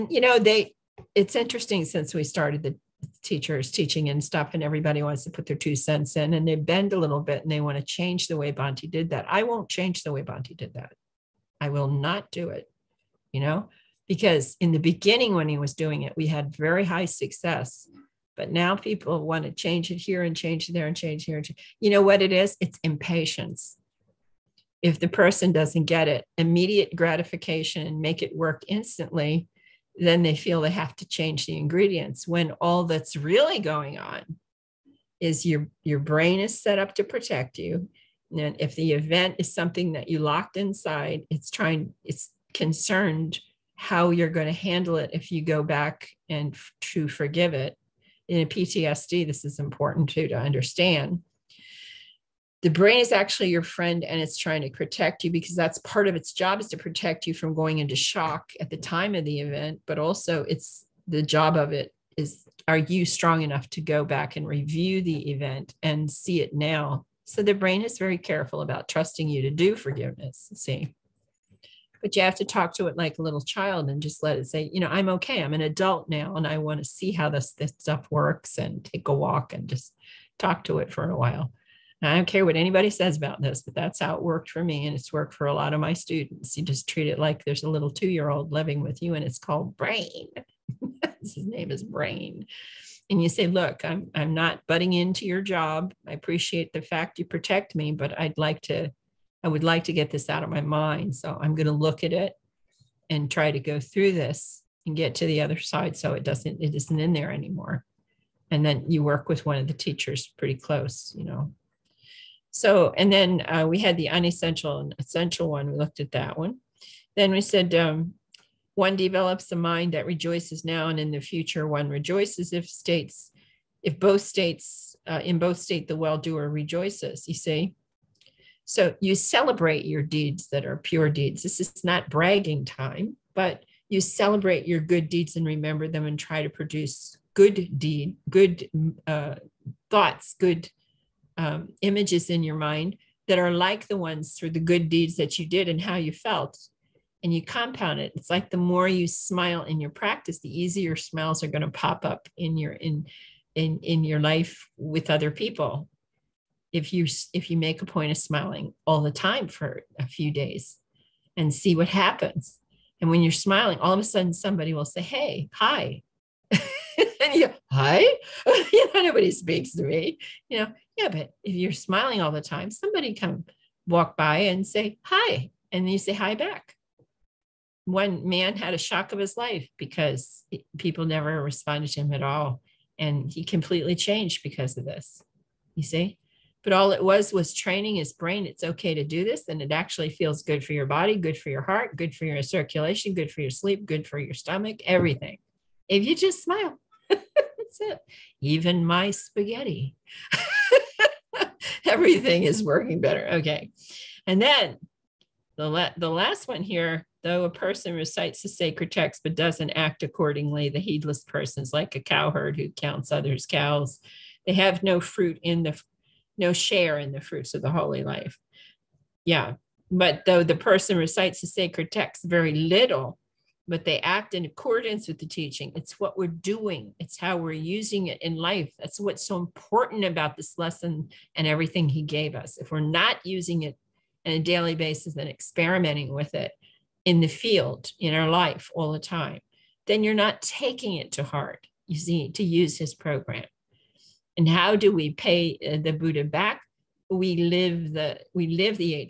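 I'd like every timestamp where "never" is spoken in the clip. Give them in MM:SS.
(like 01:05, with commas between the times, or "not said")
03:01.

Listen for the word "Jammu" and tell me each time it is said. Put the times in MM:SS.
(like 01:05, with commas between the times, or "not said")
not said.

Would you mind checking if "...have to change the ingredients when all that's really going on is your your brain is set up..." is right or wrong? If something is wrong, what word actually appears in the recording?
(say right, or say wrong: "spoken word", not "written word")
right.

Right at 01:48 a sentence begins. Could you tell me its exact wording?
And then you work with one of the teachers pretty close, you know.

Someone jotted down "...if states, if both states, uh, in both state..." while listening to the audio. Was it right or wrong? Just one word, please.
right.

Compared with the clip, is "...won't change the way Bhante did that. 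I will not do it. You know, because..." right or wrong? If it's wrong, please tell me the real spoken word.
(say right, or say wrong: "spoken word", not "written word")
right.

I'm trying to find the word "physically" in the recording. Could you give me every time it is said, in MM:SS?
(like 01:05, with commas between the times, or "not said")
not said.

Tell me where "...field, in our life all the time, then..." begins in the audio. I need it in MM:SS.
03:57.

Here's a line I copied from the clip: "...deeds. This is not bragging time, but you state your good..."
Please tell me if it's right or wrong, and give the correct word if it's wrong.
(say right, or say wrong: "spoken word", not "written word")
wrong: "celebrate", not "state".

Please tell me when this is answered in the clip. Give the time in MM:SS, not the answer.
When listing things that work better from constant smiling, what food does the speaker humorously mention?
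03:19.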